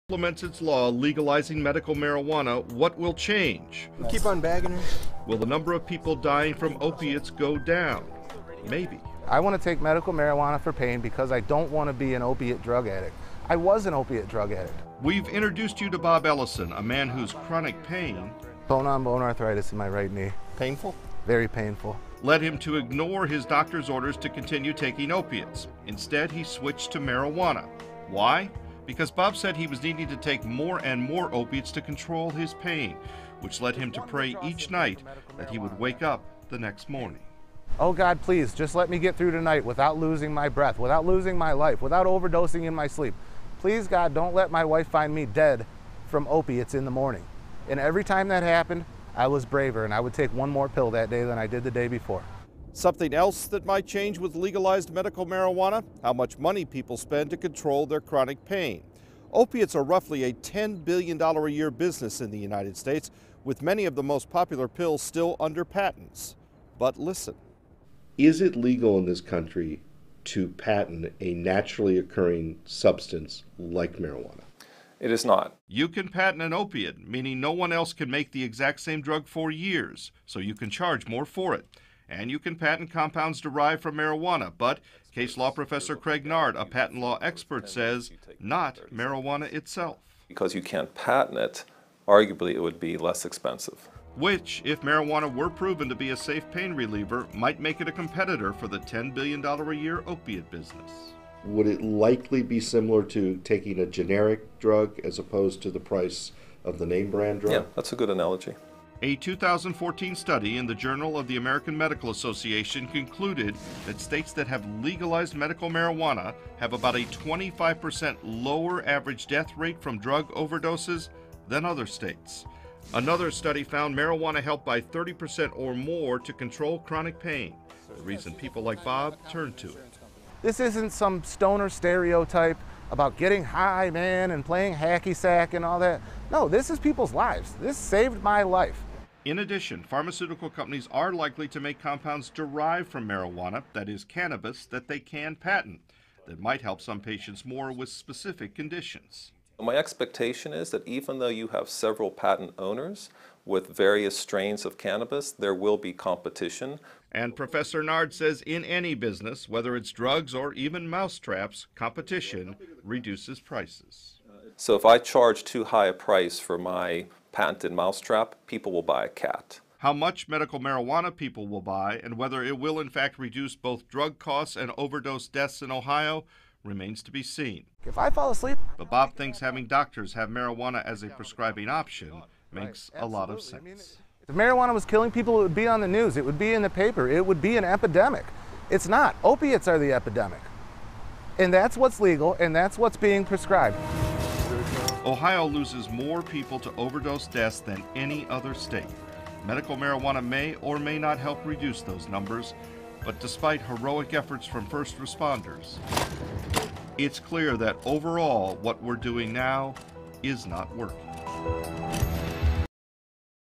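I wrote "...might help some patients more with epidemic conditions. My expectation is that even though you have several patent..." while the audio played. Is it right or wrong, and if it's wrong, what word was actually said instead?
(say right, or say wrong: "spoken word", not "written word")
wrong: "specific", not "epidemic".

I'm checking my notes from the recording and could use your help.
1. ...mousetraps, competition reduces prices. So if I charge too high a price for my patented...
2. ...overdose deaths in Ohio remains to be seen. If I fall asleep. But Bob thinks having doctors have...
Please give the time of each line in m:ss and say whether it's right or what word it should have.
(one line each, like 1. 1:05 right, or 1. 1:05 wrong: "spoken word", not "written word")
1. 2:40 right
2. 2:54 right.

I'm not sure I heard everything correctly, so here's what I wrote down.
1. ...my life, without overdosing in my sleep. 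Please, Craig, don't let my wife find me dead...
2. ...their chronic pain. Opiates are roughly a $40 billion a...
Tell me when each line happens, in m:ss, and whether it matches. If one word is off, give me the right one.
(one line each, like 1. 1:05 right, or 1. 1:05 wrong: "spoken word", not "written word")
1. 0:41 wrong: "God", not "Craig"
2. 0:57 wrong: "10", not "40".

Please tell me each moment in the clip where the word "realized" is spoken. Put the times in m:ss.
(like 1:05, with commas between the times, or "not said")
not said.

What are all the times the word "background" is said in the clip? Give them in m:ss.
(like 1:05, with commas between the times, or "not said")
not said.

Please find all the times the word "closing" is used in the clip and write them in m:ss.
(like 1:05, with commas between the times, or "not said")
not said.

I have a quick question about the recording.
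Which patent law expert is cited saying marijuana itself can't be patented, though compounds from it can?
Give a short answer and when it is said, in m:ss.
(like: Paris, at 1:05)
Craig Nard, at 1:25.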